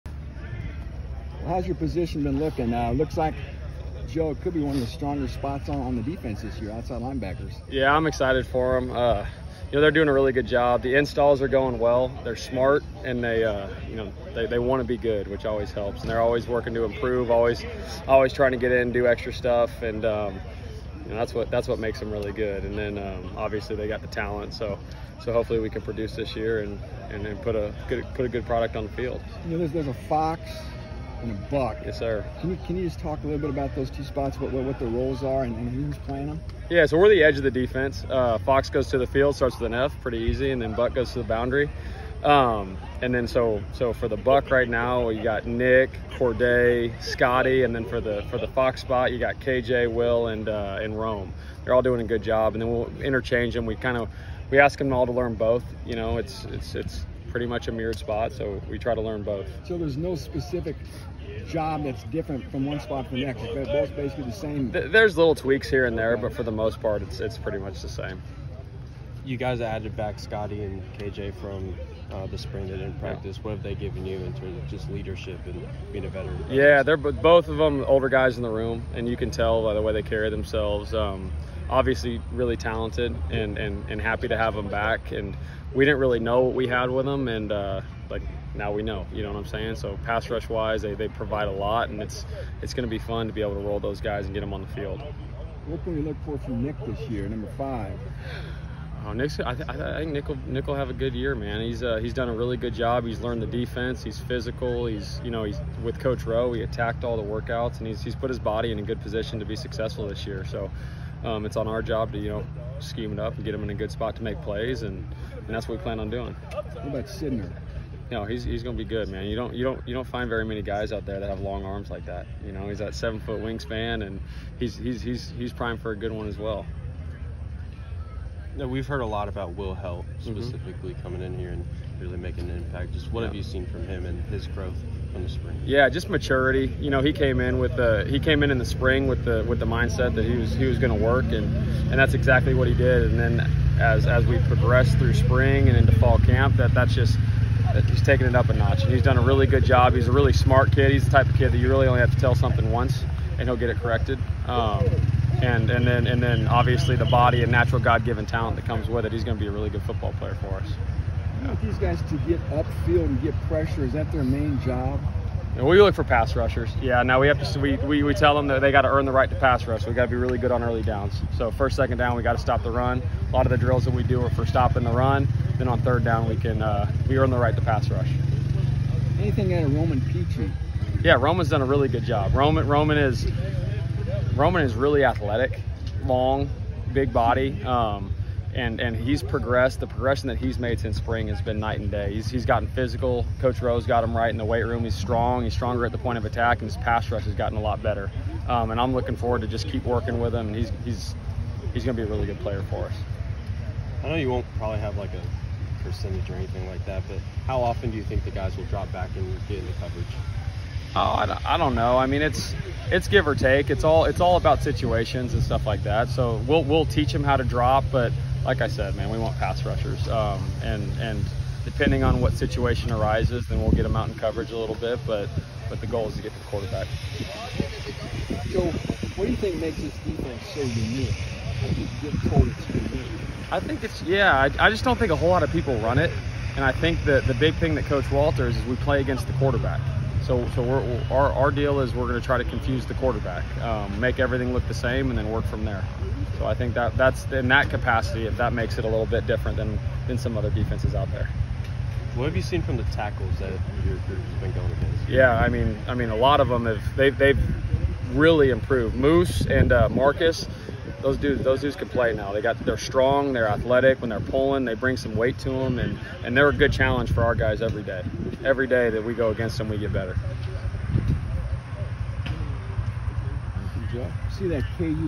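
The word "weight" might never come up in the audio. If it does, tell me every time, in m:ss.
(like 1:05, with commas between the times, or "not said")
3:14, 4:25.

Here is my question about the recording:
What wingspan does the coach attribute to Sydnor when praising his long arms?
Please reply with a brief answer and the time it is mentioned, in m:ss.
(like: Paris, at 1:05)
7 foot, at 2:02.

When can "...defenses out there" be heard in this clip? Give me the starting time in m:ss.
4:10.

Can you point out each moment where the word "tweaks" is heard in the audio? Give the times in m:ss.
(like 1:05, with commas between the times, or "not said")
1:05.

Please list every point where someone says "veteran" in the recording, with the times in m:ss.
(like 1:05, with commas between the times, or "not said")
1:16.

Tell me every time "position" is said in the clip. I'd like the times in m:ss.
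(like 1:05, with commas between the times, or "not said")
0:01, 1:49.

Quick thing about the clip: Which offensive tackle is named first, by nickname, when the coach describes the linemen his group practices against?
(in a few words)
Moose.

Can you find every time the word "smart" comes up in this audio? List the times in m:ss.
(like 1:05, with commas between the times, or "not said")
0:12, 2:30.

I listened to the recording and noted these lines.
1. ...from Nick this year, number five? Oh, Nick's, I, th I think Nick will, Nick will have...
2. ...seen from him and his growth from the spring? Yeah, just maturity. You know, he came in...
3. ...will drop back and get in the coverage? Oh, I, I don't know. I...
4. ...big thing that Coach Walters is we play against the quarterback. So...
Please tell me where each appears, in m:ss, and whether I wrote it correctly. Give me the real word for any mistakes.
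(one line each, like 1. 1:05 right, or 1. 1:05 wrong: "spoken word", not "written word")
1. 1:36 right
2. 2:13 right
3. 3:28 right
4. 3:57 right.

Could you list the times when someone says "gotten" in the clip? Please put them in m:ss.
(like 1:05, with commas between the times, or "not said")
3:12, 3:17.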